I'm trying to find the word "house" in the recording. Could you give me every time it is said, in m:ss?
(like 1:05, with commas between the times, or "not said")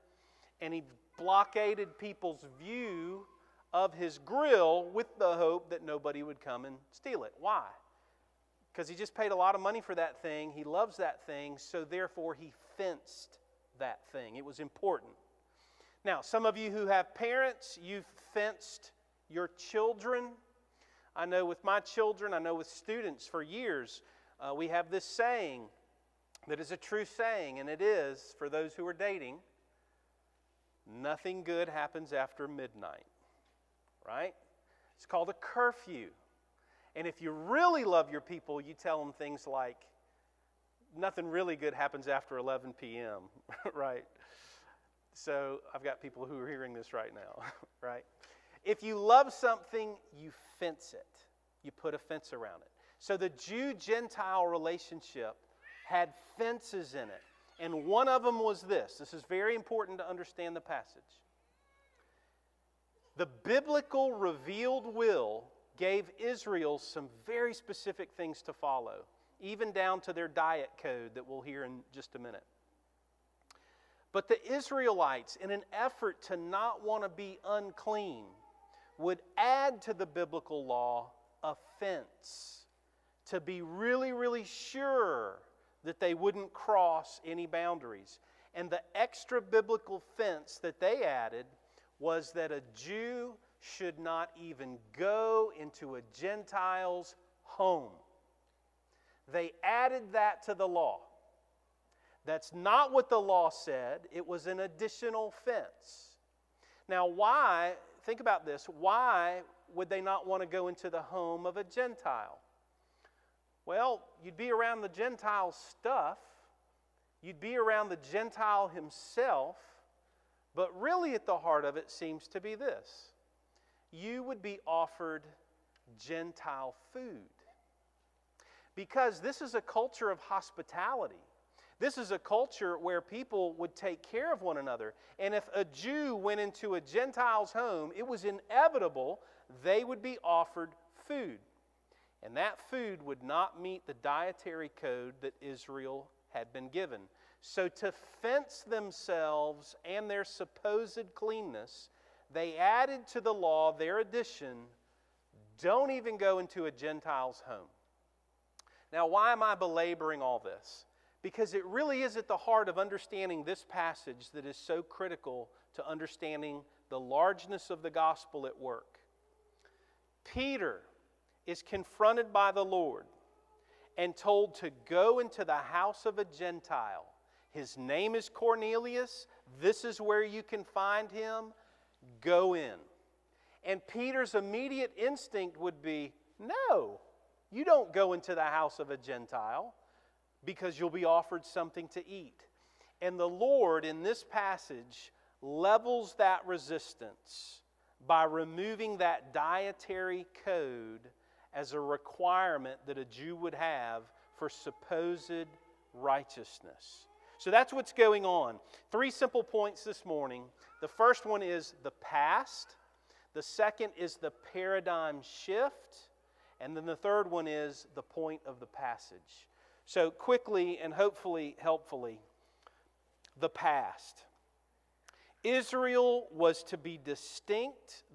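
2:55, 3:08.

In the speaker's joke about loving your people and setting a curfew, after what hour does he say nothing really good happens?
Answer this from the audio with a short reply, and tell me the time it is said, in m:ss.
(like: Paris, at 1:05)
11 p.m., at 0:42.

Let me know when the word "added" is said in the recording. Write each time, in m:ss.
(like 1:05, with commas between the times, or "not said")
1:31, 1:39, 2:32.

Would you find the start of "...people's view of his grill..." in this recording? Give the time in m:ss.
0:01.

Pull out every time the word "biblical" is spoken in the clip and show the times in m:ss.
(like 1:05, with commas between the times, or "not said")
1:03, 1:20, 1:29.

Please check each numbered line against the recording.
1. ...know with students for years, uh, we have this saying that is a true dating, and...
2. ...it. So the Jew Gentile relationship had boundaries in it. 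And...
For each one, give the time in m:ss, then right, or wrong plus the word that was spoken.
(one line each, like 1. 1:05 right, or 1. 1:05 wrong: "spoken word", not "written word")
1. 0:22 wrong: "saying", not "dating"
2. 0:52 wrong: "fences", not "boundaries".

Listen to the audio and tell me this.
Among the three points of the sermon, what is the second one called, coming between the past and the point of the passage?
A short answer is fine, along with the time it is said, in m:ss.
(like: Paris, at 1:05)
paradigm shift, at 3:34.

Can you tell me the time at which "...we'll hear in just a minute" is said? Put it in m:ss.
1:11.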